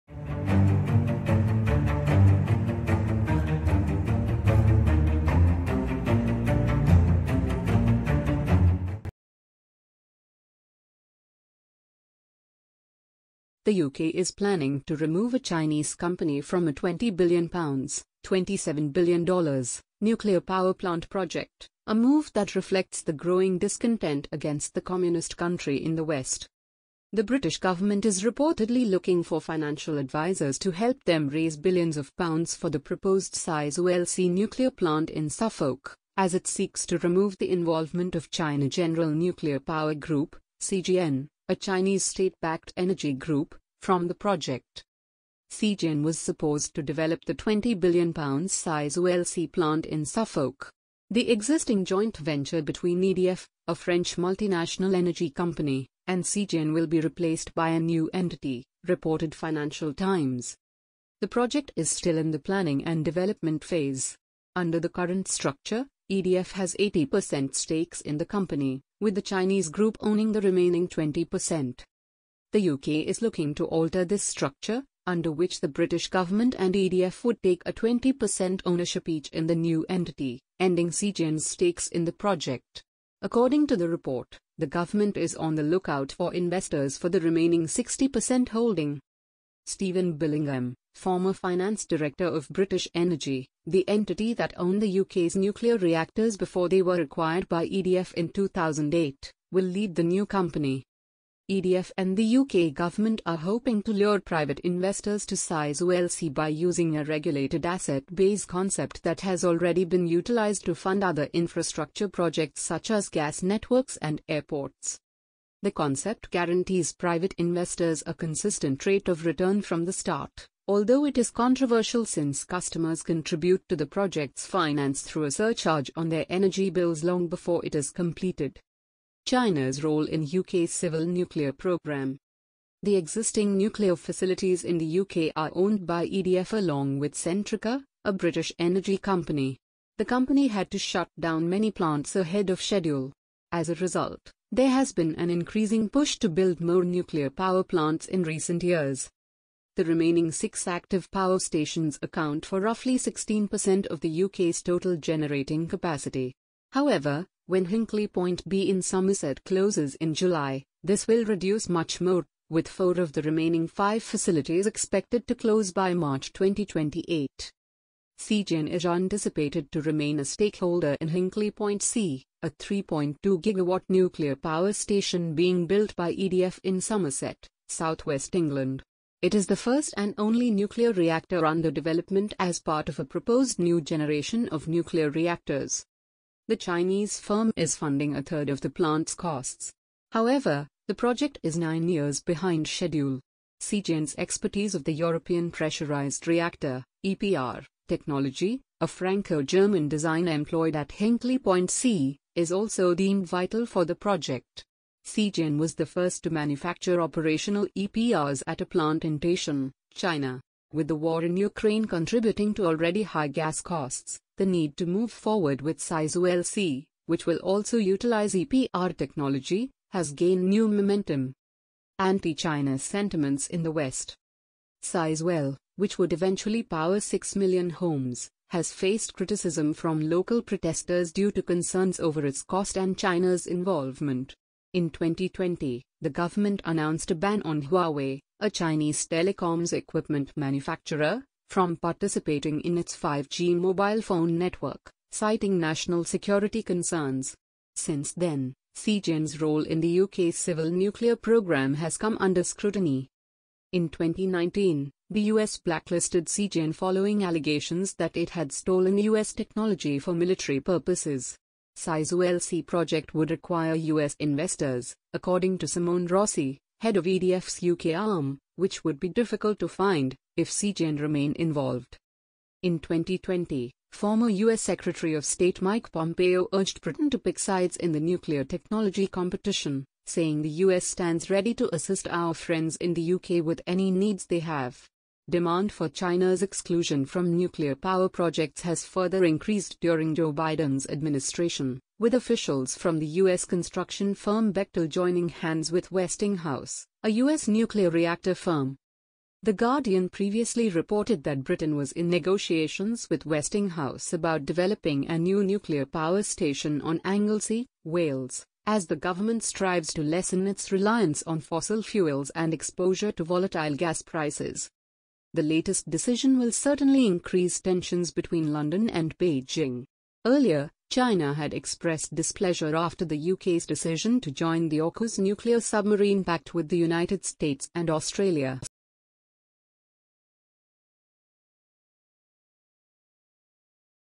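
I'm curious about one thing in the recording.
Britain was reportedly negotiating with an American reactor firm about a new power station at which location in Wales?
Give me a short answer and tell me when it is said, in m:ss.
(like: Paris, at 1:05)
Anglesey, at 5:07.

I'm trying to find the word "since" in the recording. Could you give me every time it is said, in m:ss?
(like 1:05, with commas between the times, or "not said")
2:02, 4:07.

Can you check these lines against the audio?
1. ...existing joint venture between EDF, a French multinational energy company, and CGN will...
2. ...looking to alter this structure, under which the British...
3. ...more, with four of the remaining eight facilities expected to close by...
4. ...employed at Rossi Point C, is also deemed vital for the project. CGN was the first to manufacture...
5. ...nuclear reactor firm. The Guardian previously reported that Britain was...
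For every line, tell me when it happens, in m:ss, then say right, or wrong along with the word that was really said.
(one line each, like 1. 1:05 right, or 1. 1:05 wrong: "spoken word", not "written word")
1. 0:51 right
2. 1:13 right
3. 2:42 wrong: "five", not "eight"
4. 3:20 wrong: "Hinkley", not "Rossi"
5. 4:57 right.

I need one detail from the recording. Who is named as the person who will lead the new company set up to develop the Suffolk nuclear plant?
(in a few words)
Stephen Billingham.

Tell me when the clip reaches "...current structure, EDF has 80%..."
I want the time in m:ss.
1:04.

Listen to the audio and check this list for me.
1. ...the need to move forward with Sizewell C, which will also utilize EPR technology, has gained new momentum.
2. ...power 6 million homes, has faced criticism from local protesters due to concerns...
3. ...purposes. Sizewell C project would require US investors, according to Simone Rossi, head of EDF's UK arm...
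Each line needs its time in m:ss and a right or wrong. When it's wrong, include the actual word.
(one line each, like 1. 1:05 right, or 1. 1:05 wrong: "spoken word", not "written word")
1. 3:34 right
2. 3:46 right
3. 4:20 right.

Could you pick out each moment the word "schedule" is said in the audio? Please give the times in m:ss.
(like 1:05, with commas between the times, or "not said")
2:22, 3:12.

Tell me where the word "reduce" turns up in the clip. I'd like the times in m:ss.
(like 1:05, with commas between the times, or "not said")
2:41.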